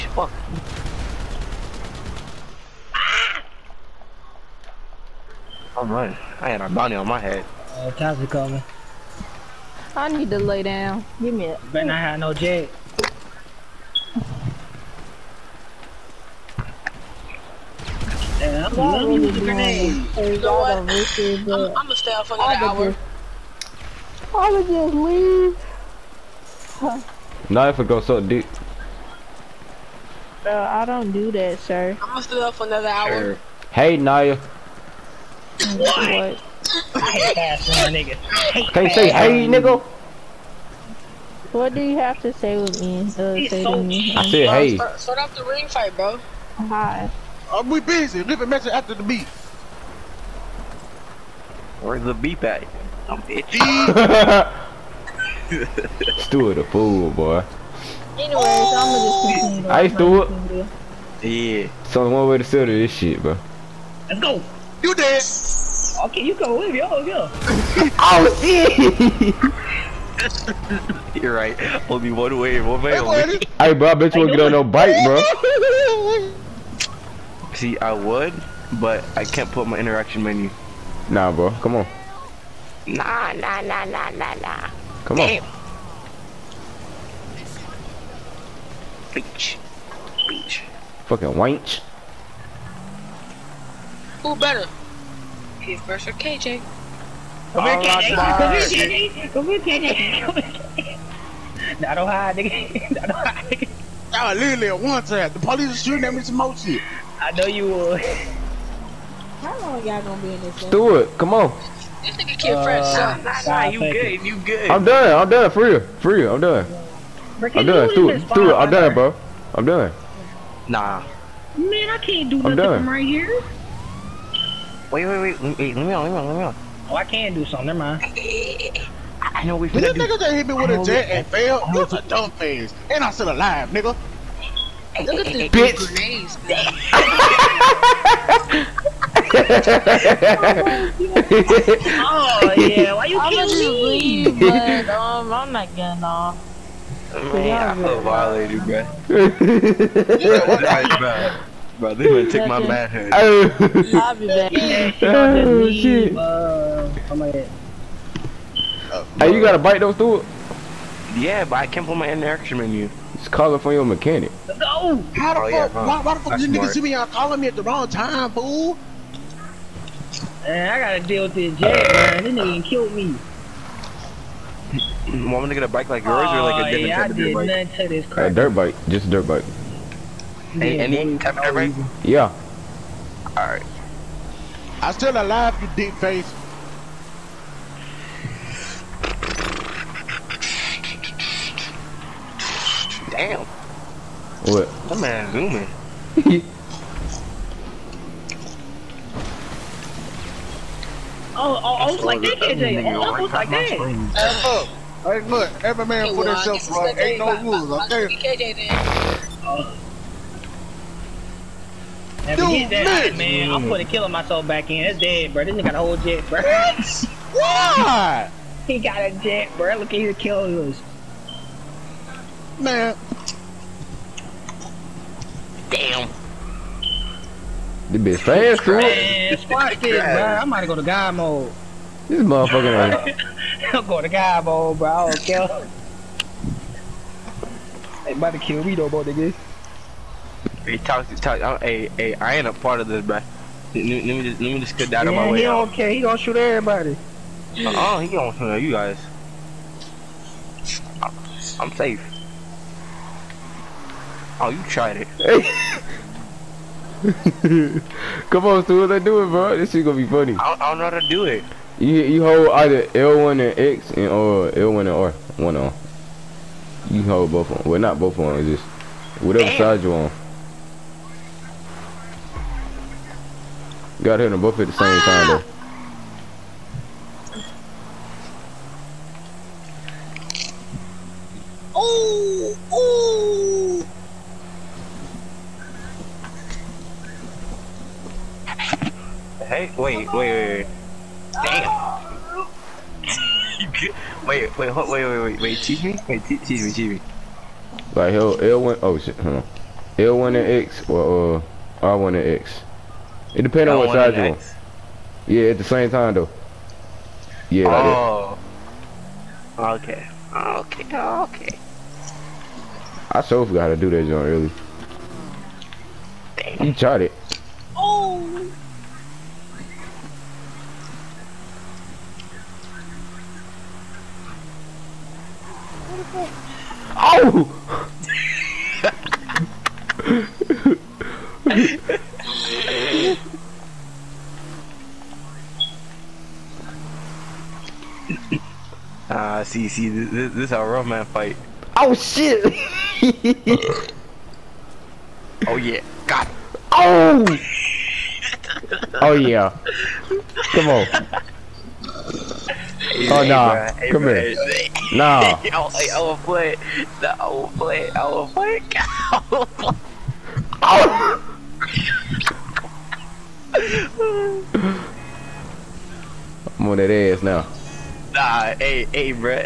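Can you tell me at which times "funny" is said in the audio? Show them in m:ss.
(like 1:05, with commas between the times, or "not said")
4:20.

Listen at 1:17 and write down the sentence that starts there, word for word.
See, I would, but I can't put my interaction menu.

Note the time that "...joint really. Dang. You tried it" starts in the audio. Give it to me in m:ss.
5:14.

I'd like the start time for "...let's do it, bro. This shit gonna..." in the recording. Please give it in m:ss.
4:18.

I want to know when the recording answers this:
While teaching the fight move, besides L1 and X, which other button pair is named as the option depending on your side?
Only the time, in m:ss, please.
5:01.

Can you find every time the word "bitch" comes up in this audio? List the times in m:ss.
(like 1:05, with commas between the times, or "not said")
2:15, 3:48.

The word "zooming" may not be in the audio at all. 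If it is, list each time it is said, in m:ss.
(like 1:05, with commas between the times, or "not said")
3:15.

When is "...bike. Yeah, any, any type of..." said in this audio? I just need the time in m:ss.
2:59.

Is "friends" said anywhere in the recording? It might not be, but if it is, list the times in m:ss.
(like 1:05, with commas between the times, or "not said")
1:52.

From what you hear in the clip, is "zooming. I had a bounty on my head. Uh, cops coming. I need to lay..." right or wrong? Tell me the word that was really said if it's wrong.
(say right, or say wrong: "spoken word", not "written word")
wrong: "running", not "zooming".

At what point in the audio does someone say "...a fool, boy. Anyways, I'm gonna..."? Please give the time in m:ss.
0:56.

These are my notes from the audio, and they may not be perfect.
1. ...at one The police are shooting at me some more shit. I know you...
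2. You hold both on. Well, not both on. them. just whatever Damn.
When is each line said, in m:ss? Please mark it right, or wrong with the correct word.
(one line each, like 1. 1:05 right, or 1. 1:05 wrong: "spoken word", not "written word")
1. 1:44 right
2. 4:26 right.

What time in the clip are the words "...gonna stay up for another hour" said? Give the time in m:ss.
0:32.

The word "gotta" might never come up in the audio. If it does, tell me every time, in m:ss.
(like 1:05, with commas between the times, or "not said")
2:39, 2:50, 4:34.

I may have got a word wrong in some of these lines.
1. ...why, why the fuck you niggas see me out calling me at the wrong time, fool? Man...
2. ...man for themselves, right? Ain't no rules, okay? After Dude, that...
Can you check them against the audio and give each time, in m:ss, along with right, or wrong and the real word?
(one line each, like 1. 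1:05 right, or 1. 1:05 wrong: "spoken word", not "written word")
1. 2:45 right
2. 3:25 right.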